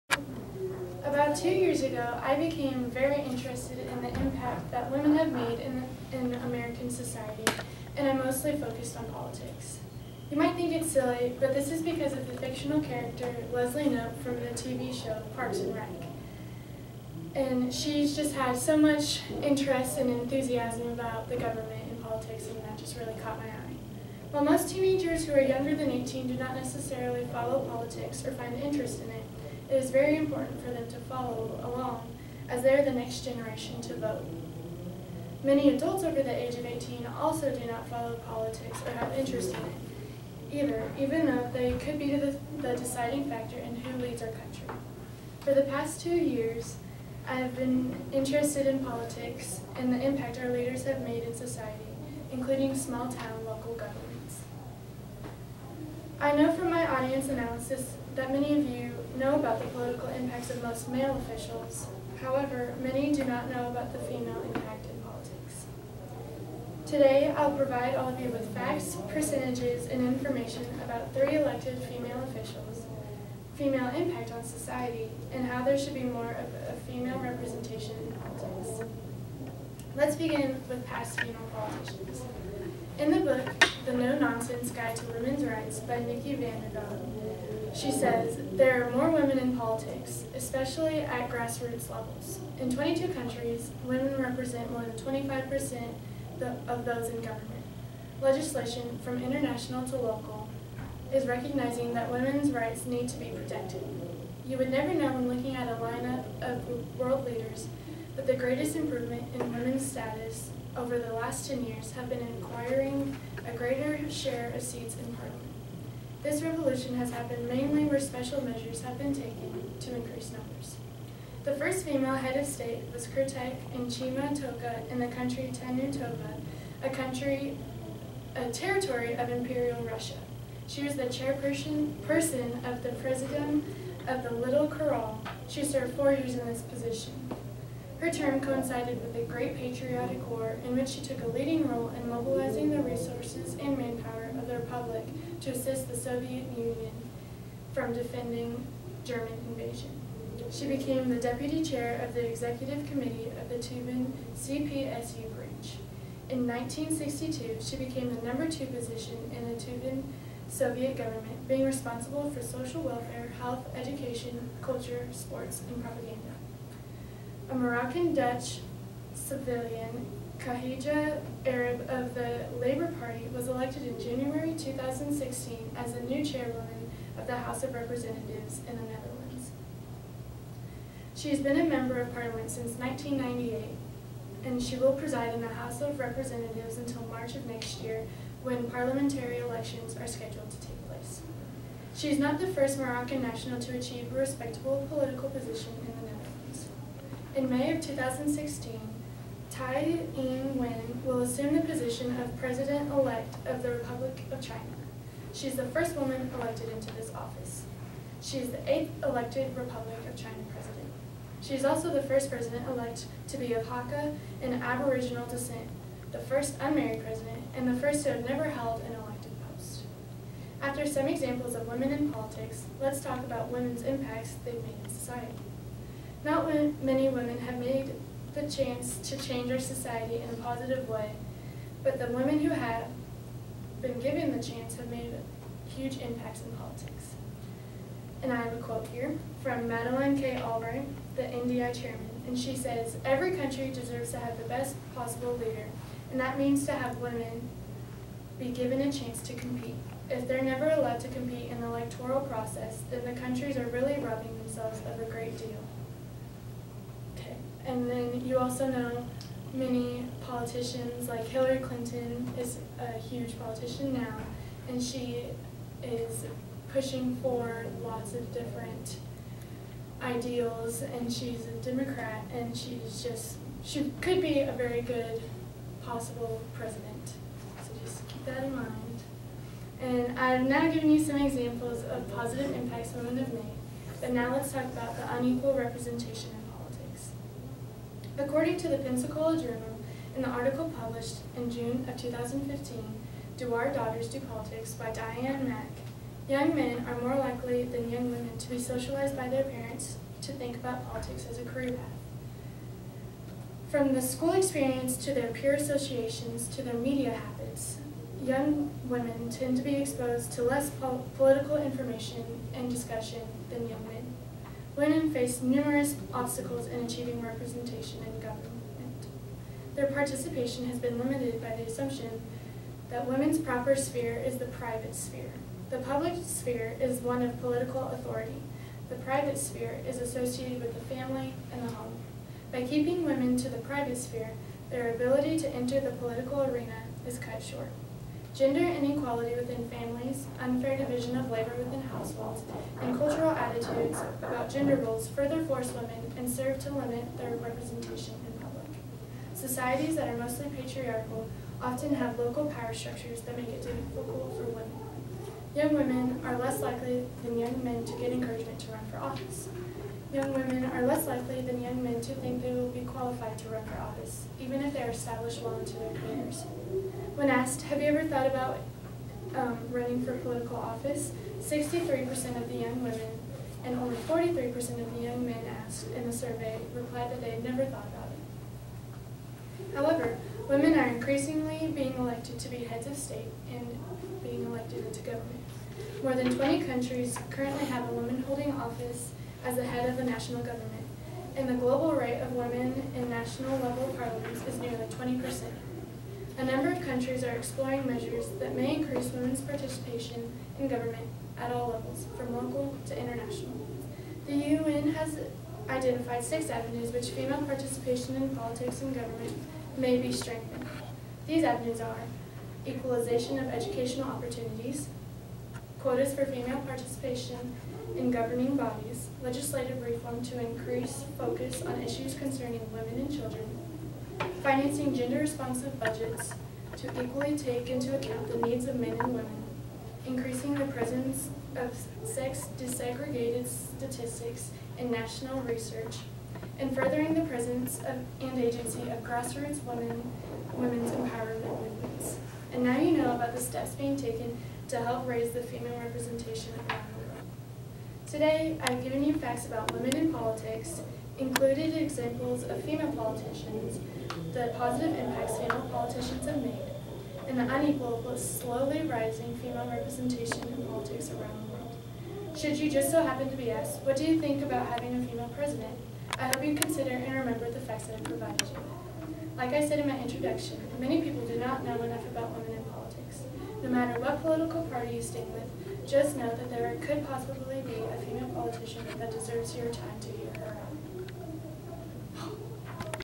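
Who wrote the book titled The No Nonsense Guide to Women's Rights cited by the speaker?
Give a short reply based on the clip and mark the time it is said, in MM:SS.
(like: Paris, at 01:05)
Nikki Vanderdonk, at 01:25.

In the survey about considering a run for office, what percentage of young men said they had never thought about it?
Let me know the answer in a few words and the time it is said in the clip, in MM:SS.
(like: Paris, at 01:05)
43%, at 06:13.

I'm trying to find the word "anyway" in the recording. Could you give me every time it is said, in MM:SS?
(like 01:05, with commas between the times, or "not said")
not said.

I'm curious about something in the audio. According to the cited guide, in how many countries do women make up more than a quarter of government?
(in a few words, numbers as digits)
22.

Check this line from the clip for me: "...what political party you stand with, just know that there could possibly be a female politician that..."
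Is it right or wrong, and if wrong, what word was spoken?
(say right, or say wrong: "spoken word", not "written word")
right.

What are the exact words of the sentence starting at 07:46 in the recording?
I hope you consider and remember the facts that I provided you.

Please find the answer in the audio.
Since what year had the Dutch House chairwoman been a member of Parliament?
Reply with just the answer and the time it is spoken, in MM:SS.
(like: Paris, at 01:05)
1998, at 03:02.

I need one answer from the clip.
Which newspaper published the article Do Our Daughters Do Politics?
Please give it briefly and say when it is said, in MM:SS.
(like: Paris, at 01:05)
Pensacola Journal, at 04:48.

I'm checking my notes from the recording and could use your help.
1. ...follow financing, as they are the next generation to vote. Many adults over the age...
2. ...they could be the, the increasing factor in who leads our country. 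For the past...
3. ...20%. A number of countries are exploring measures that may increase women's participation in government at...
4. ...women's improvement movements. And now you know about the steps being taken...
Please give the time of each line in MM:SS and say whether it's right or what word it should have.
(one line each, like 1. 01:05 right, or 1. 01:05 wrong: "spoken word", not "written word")
1. 00:30 wrong: "along", not "financing"
2. 00:41 wrong: "deciding", not "increasing"
3. 06:34 right
4. 07:20 wrong: "empowerment", not "improvement".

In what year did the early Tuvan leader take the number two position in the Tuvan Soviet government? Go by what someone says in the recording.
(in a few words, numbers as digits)
1962.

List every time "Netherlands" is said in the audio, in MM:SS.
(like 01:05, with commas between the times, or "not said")
02:58, 03:16.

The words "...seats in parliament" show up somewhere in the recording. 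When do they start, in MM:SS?
01:54.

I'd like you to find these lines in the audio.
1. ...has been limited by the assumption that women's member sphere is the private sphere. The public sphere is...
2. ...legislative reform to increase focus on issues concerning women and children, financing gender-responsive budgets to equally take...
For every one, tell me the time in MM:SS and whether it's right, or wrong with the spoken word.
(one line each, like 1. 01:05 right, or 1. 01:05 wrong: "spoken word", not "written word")
1. 05:20 wrong: "proper", not "member"
2. 06:59 right.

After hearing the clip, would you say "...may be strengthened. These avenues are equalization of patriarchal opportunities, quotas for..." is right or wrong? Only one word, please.
wrong.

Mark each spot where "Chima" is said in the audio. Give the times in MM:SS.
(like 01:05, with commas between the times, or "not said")
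02:03.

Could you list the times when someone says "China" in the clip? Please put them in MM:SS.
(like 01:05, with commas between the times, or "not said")
03:24, 03:30.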